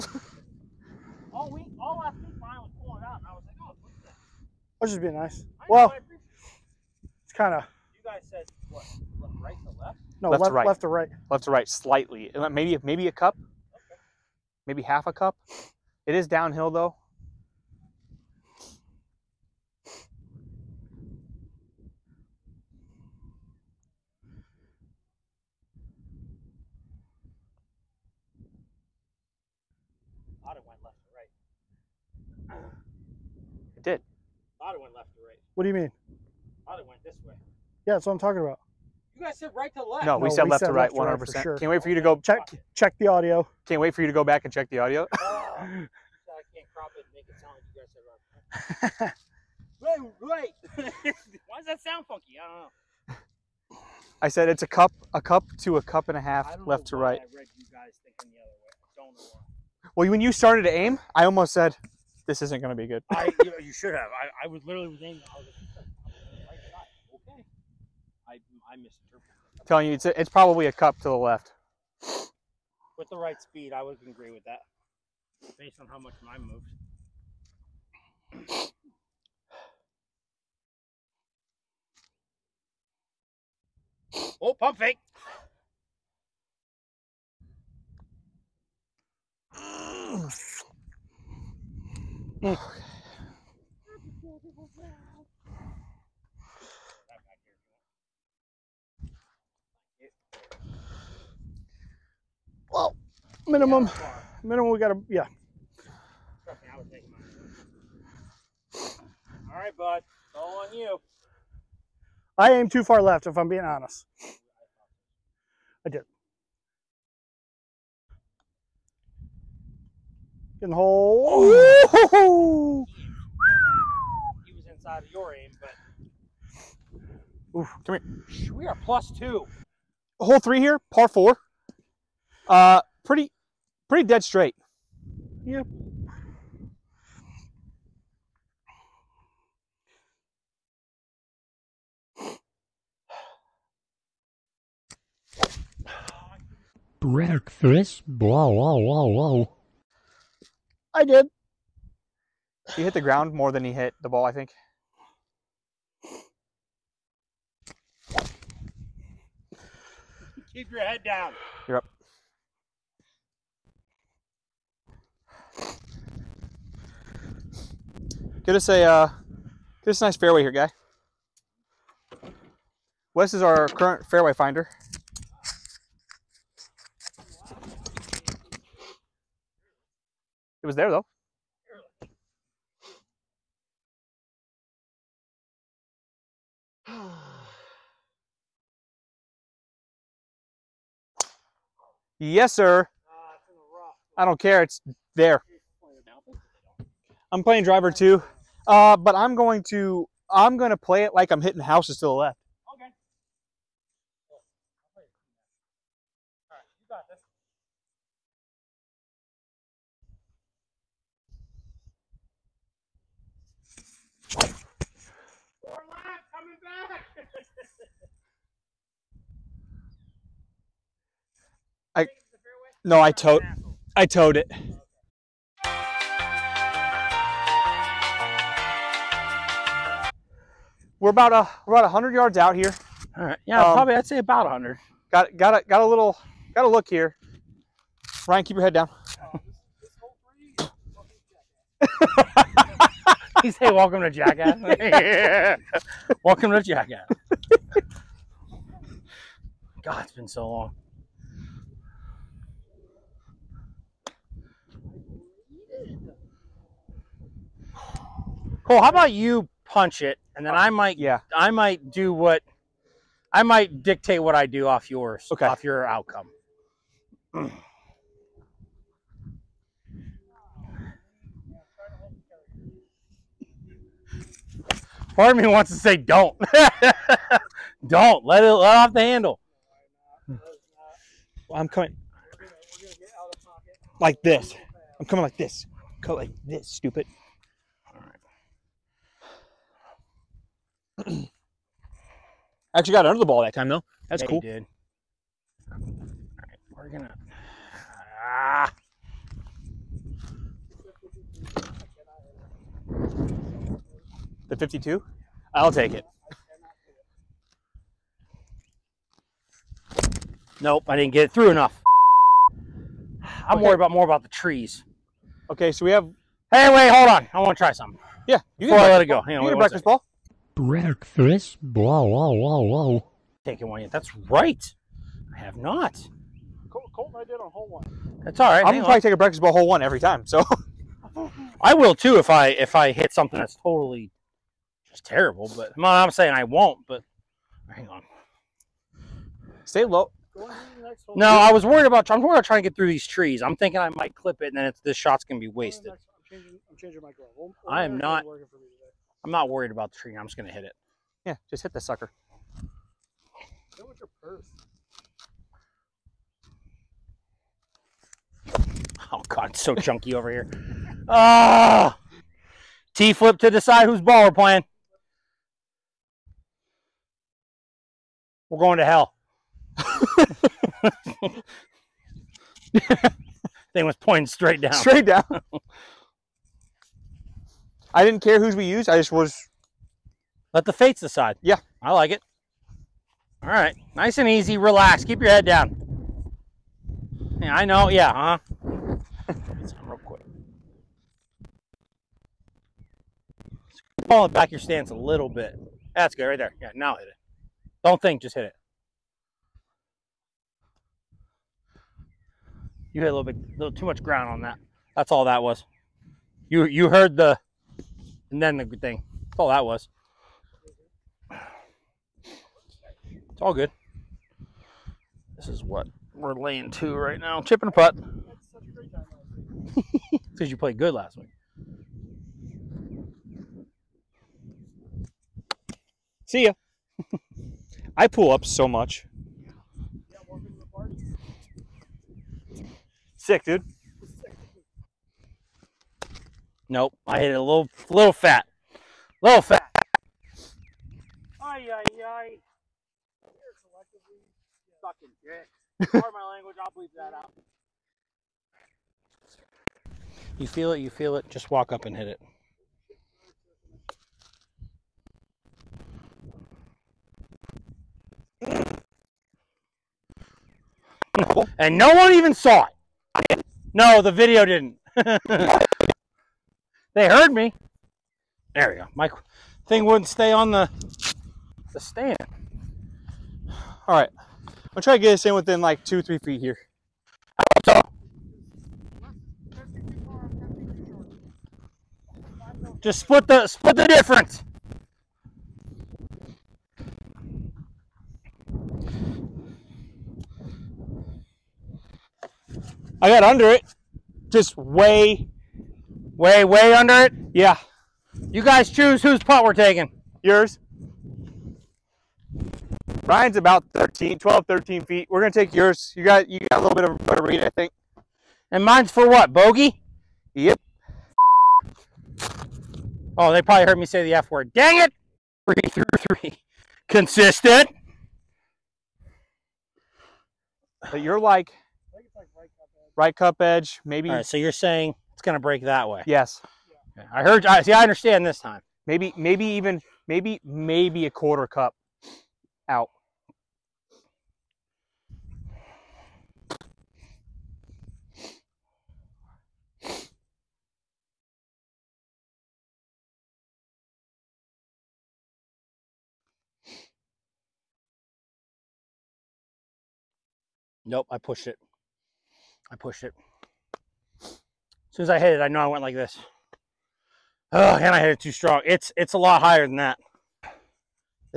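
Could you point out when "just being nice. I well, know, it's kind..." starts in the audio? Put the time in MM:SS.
00:04.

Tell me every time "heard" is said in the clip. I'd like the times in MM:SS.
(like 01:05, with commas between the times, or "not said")
06:46, 07:47, 08:33, 08:47.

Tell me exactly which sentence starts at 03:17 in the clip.
I'm playing driver two, uh, but I'm going to I'm going to play it like I'm hitting houses to the left.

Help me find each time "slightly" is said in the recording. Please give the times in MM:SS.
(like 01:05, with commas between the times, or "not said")
00:11.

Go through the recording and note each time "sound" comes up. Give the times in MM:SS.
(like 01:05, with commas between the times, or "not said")
00:47, 00:51.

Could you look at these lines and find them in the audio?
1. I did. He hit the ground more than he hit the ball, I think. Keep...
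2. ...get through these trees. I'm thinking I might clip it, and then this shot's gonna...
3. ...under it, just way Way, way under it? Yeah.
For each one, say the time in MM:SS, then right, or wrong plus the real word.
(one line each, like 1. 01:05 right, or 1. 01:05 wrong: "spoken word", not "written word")
1. 02:30 right
2. 05:42 right
3. 08:13 right.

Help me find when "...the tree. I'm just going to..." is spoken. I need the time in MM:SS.
05:49.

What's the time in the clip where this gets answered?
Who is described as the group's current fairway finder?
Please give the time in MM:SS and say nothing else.
02:53.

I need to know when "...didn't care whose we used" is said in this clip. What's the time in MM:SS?
06:18.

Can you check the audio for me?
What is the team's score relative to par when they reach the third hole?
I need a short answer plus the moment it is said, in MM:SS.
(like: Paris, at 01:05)
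plus 2, at 02:08.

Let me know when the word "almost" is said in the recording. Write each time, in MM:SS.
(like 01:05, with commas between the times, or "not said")
01:01.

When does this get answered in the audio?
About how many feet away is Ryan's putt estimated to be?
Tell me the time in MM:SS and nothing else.
08:24.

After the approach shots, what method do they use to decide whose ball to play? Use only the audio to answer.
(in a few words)
T-flip.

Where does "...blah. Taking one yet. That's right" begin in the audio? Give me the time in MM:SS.
05:22.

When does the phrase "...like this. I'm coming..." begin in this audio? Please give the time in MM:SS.
04:43.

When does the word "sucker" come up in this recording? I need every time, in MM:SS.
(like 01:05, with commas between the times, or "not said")
05:51.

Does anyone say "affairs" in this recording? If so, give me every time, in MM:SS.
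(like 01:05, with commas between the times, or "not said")
not said.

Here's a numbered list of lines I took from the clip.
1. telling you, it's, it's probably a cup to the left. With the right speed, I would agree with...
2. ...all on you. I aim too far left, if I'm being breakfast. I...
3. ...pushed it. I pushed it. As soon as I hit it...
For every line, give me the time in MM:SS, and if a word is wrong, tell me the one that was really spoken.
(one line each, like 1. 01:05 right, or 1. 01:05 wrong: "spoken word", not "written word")
1. 01:09 right
2. 01:50 wrong: "honest", not "breakfast"
3. 09:11 right.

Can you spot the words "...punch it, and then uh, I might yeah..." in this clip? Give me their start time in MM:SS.
04:19.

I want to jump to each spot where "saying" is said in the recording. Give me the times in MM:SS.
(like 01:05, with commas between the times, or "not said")
05:36, 08:44.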